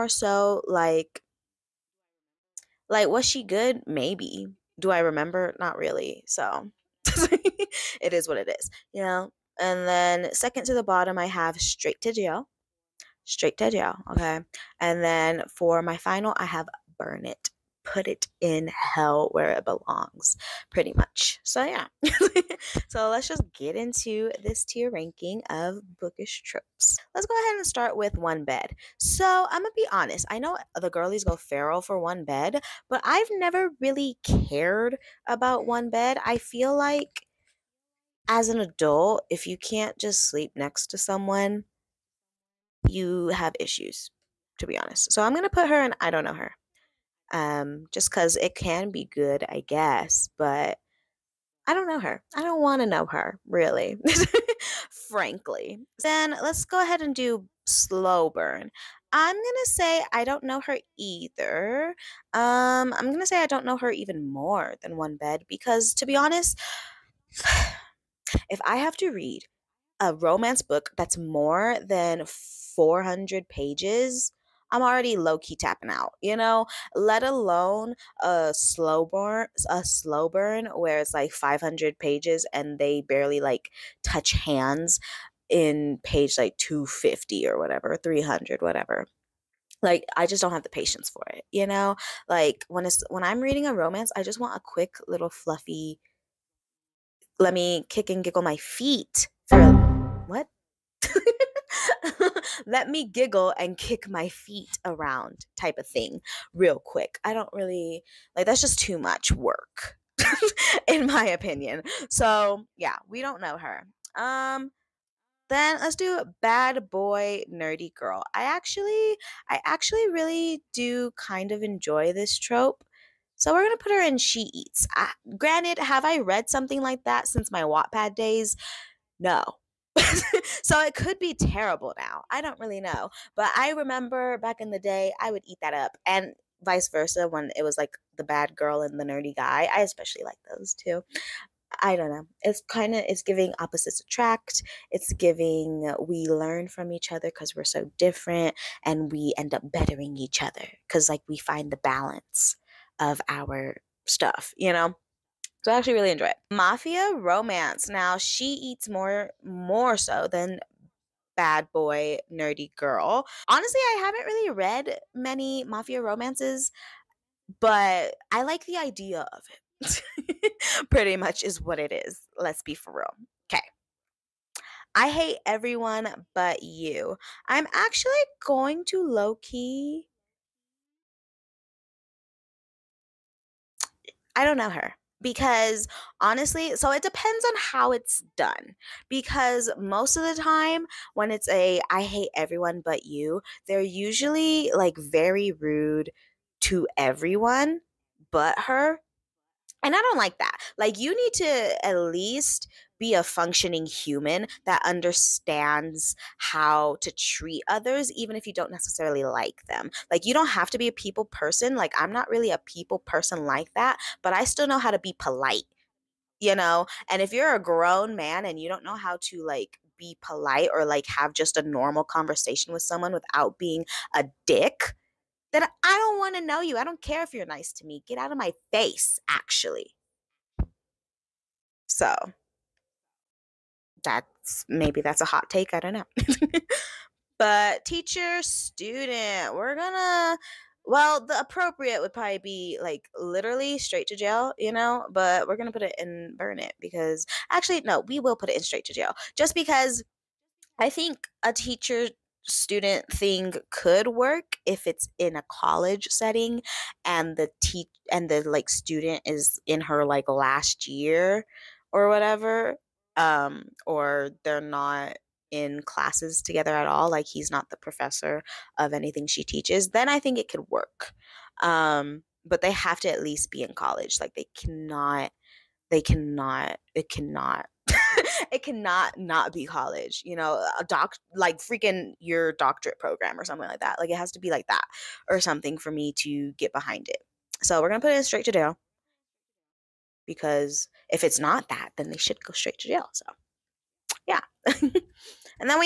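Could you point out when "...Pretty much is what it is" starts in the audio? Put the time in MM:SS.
02:50.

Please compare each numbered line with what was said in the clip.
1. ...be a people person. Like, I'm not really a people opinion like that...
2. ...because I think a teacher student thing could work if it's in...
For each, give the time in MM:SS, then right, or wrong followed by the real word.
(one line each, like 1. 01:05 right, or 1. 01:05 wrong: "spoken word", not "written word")
1. 03:30 wrong: "person", not "opinion"
2. 04:09 right.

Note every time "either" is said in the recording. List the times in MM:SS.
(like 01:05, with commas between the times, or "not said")
01:00.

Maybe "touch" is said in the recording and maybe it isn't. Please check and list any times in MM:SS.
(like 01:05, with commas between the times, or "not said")
01:24.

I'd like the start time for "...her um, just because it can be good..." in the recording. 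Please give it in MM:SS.
00:46.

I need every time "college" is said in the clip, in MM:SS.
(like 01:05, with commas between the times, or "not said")
04:15, 04:33, 04:39.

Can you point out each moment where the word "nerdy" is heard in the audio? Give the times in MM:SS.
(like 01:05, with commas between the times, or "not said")
01:57, 02:19, 02:42.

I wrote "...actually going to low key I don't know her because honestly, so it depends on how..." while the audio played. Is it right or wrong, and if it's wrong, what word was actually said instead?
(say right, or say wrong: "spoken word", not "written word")
right.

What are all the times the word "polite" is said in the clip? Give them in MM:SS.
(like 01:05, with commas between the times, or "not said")
03:35, 03:40.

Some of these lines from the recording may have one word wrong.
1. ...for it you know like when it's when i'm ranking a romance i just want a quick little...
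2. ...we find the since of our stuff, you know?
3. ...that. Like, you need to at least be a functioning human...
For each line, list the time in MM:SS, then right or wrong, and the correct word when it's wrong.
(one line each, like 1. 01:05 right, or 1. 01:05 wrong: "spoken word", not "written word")
1. 01:31 wrong: "reading", not "ranking"
2. 02:31 wrong: "balance", not "since"
3. 03:20 right.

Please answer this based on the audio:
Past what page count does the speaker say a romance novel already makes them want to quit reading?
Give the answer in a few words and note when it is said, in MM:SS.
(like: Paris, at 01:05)
400, at 01:12.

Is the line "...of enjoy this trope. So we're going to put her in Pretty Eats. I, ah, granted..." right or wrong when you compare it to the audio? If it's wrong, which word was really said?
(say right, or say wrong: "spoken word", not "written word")
wrong: "She", not "Pretty".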